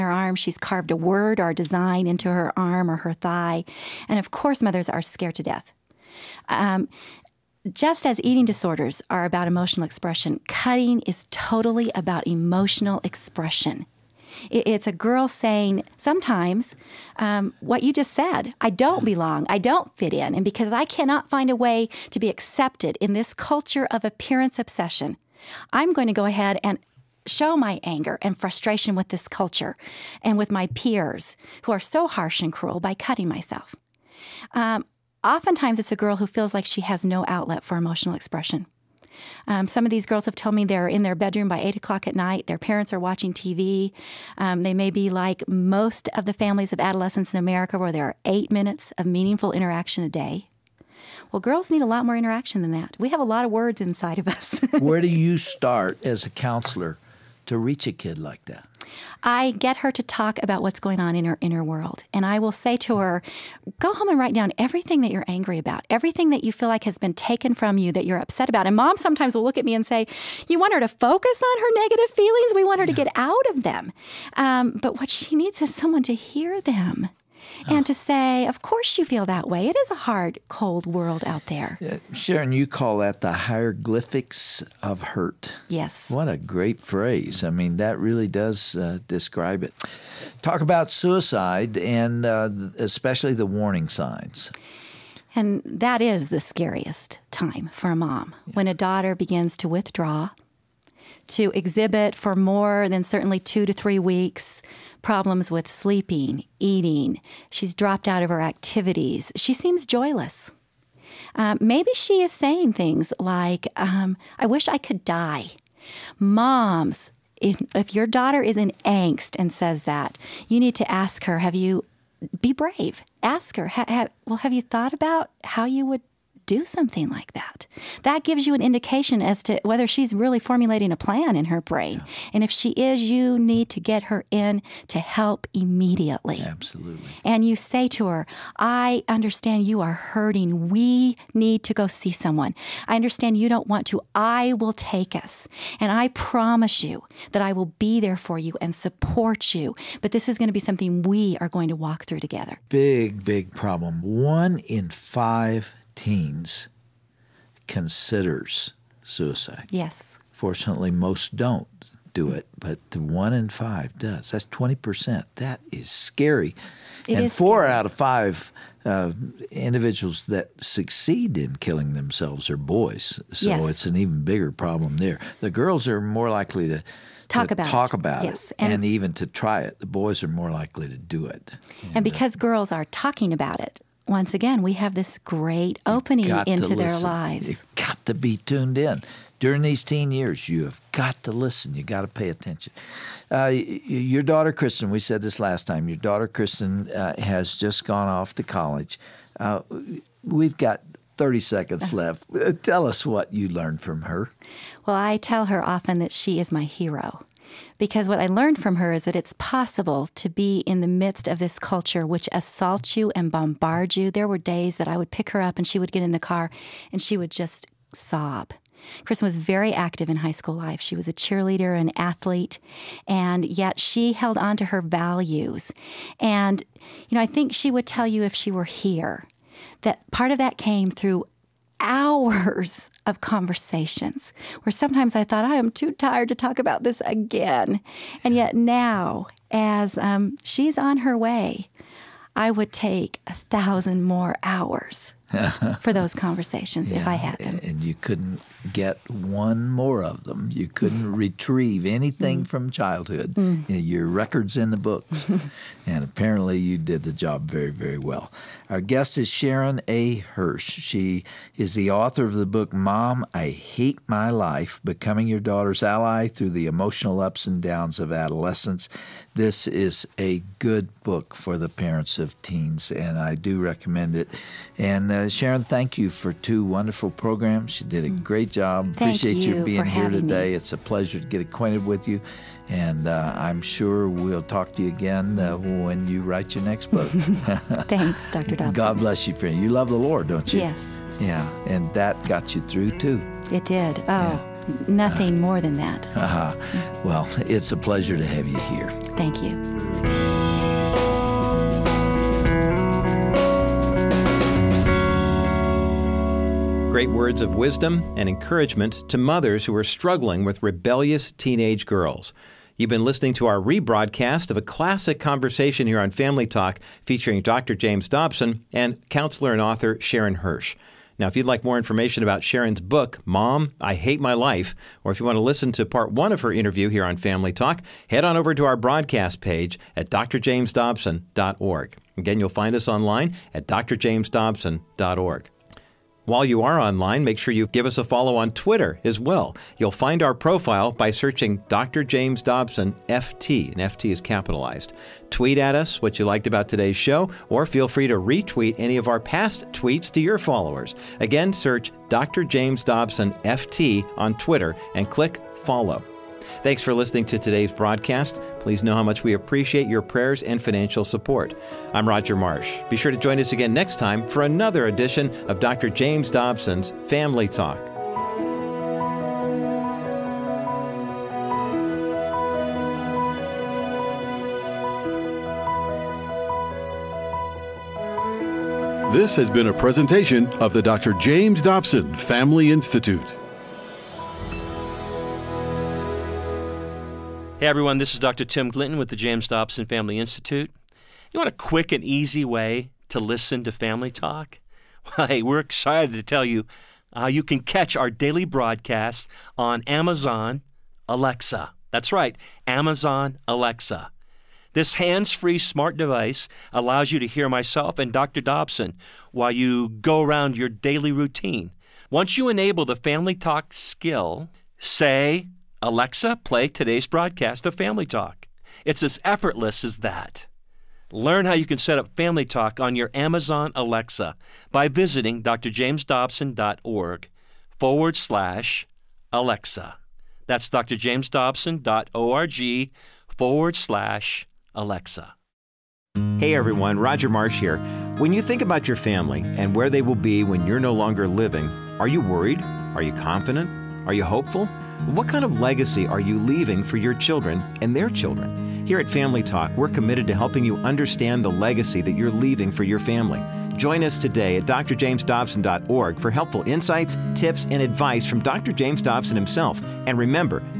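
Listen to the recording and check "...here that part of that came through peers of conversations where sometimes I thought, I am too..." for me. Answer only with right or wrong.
wrong.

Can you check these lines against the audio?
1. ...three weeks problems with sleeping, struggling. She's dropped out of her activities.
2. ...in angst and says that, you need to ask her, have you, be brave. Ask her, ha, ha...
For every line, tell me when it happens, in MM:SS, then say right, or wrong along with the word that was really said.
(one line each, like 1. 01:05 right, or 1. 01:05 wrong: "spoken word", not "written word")
1. 01:43 wrong: "eating", not "struggling"
2. 01:58 right.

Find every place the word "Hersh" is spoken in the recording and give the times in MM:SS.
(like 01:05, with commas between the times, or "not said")
04:20, 05:20.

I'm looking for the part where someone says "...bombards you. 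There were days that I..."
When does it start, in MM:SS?
03:33.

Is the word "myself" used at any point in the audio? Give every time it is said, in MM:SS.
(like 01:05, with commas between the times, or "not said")
00:33, 06:47.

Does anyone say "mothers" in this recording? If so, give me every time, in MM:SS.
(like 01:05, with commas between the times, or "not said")
00:04, 05:09.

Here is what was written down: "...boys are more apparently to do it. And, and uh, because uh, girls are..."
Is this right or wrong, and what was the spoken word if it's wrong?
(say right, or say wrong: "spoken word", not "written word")
wrong: "likely", not "apparently".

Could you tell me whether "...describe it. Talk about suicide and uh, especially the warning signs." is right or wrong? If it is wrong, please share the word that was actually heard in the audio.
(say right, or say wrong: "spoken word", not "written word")
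right.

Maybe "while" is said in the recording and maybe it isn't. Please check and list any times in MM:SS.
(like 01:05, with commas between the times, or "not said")
05:36, 06:49.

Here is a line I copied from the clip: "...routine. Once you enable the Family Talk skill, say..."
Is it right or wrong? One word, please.
right.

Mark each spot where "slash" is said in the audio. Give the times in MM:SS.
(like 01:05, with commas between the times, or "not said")
07:08, 07:13.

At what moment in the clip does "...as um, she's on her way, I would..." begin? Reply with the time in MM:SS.
03:59.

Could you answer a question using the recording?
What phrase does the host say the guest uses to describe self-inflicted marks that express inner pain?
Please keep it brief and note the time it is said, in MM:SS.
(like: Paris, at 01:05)
the hieroglyphics of hurt, at 01:23.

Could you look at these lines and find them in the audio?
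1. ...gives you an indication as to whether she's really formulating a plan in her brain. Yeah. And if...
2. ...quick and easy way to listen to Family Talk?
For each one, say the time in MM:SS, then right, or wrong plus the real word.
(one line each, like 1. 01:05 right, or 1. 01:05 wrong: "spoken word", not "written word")
1. 02:08 right
2. 06:31 right.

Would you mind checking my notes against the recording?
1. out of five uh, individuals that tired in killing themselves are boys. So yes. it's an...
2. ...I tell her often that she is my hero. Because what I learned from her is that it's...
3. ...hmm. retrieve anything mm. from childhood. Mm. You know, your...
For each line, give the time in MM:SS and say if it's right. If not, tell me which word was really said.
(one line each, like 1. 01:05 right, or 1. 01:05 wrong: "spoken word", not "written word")
1. 02:47 wrong: "succeed", not "tired"
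2. 03:24 right
3. 04:11 right.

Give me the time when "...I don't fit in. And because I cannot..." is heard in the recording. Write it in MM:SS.
00:19.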